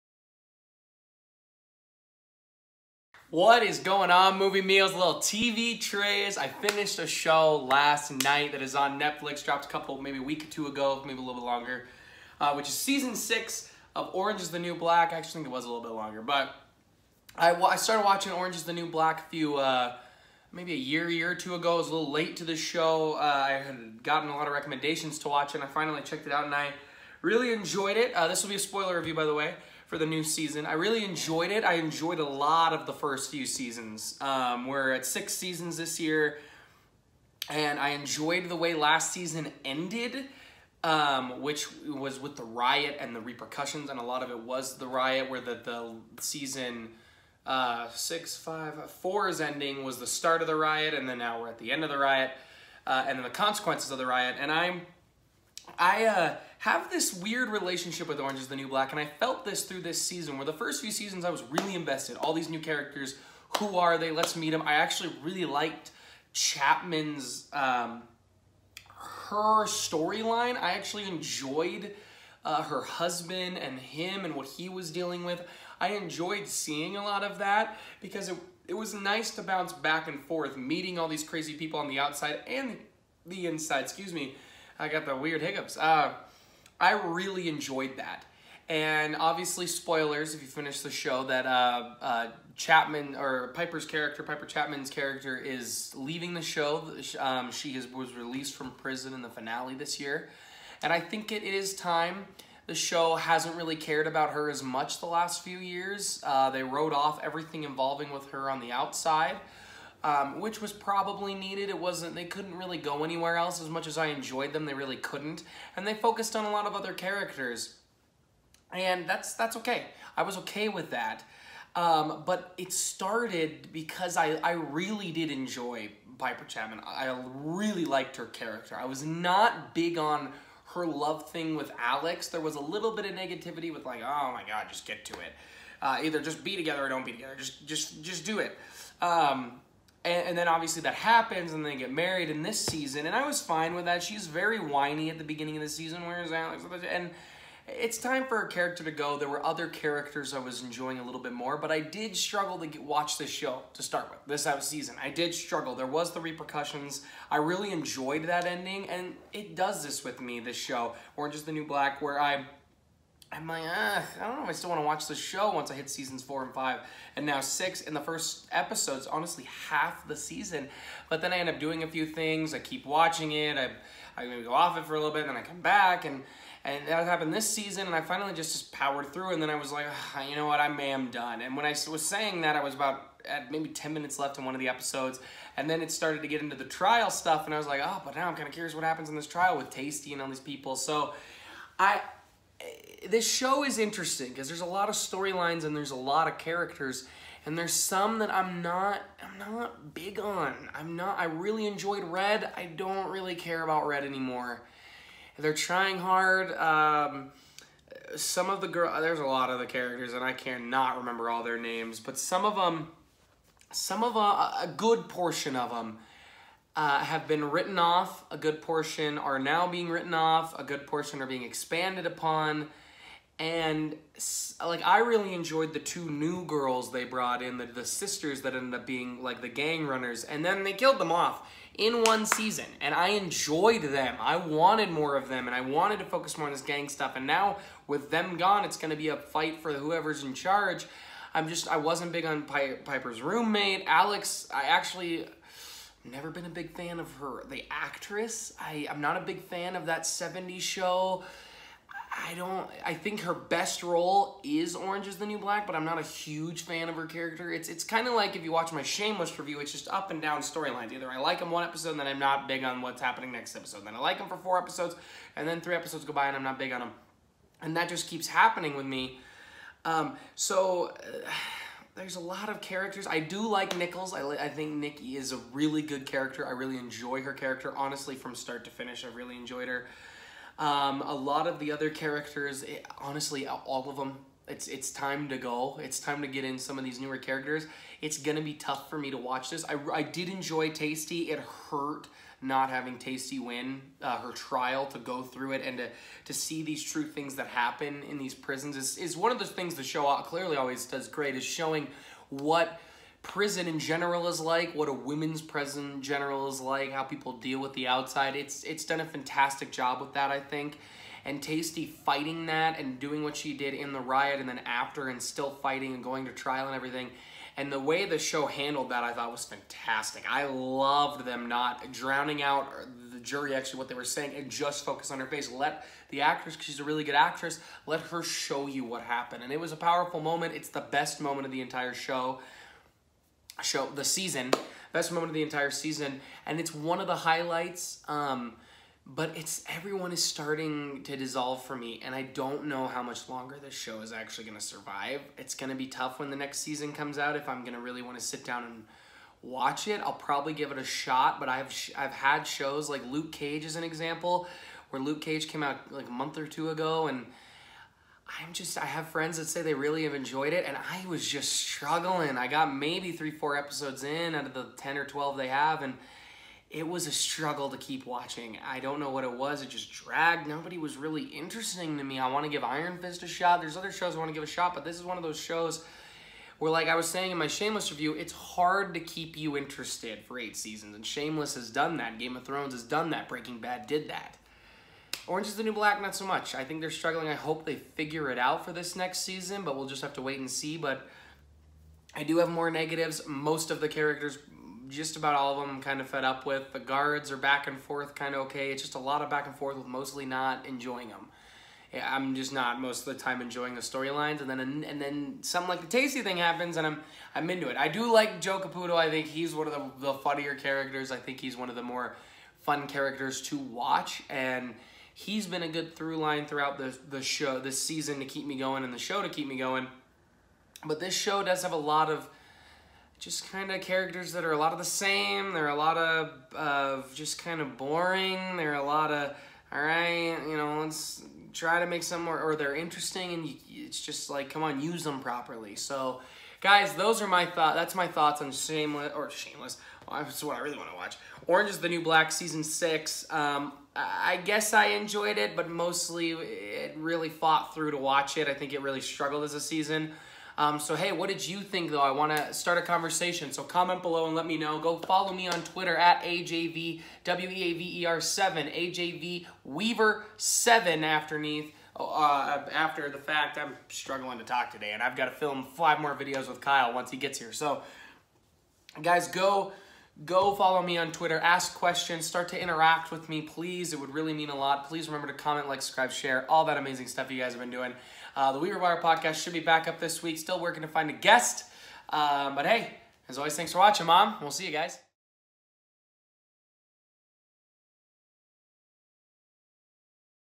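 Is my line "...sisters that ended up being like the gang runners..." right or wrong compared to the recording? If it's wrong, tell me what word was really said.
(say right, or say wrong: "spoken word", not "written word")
right.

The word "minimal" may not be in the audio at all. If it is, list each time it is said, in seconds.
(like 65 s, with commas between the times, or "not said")
not said.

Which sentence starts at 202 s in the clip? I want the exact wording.
I don't really care about Red anymore.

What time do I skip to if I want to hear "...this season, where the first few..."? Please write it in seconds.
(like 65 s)
59 s.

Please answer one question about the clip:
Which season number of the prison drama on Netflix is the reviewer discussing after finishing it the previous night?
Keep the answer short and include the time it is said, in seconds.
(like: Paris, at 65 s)
6, at 12 s.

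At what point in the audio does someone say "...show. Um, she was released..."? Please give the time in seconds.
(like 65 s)
96 s.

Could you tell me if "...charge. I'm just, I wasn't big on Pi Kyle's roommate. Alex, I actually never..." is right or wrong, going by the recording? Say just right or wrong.
wrong.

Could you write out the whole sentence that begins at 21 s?
I was a little late to the show.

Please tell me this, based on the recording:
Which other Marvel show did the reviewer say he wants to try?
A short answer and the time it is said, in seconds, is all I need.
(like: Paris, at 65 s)
Iron Fist, at 372 s.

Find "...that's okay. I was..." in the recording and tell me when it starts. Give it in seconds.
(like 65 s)
119 s.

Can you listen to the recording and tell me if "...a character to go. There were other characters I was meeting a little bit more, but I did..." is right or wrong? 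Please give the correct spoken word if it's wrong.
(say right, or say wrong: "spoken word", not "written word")
wrong: "enjoying", not "meeting".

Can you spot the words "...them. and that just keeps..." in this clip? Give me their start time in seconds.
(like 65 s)
266 s.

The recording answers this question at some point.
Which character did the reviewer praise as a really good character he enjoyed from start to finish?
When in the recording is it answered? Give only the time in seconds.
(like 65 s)
274 s.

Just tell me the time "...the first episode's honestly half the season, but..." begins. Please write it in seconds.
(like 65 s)
167 s.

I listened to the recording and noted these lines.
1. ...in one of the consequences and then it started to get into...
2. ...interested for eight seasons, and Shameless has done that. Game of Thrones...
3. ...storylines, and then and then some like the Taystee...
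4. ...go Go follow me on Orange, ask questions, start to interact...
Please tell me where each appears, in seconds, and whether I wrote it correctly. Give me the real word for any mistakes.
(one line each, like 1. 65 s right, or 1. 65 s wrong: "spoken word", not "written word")
1. 184 s wrong: "episodes", not "consequences"
2. 379 s right
3. 403 s right
4. 469 s wrong: "Twitter", not "Orange".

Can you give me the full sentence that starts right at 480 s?
Still working to find a guest.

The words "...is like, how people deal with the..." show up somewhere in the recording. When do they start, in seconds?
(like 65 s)
306 s.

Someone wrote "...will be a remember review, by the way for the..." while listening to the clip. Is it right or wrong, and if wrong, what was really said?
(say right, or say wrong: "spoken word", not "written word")
wrong: "spoiler", not "remember".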